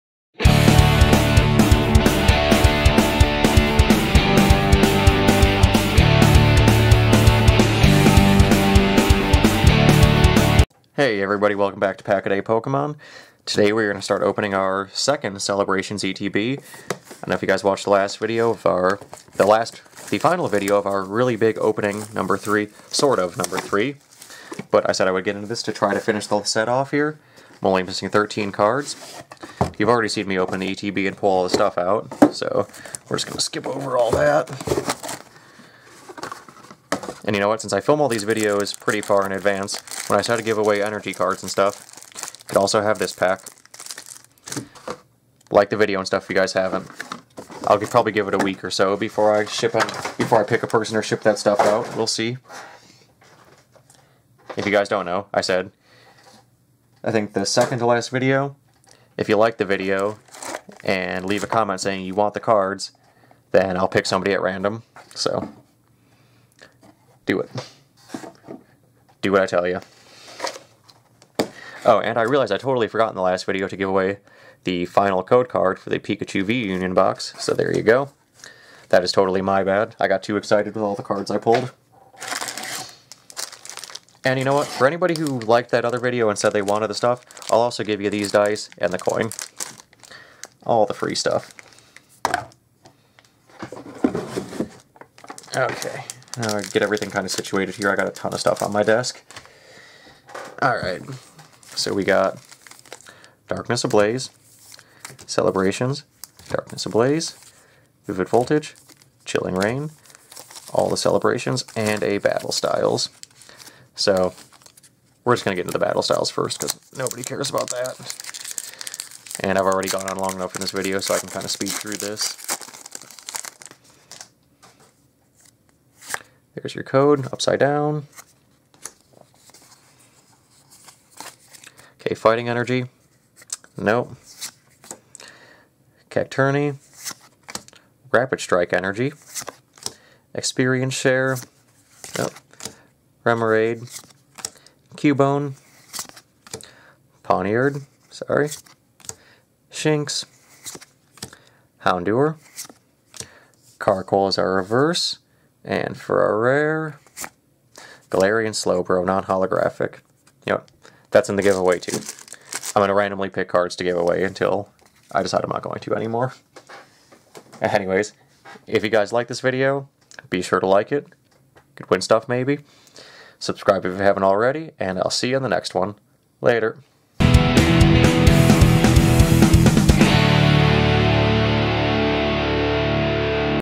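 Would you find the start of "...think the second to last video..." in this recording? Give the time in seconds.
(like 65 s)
57 s.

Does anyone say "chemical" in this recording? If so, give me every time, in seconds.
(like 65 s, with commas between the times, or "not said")
not said.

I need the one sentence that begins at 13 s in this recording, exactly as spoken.
Today we're going to start opening our second Celebrations ETB.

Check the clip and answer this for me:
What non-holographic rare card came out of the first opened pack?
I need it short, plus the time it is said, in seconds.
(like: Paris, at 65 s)
Galarian Slowbro, at 158 s.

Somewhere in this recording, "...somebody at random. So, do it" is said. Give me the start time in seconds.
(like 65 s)
64 s.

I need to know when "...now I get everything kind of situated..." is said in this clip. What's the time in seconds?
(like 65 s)
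96 s.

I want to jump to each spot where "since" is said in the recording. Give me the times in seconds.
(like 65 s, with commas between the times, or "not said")
37 s.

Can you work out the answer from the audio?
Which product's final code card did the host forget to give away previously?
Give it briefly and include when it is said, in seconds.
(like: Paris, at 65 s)
Pikachu V Union box, at 75 s.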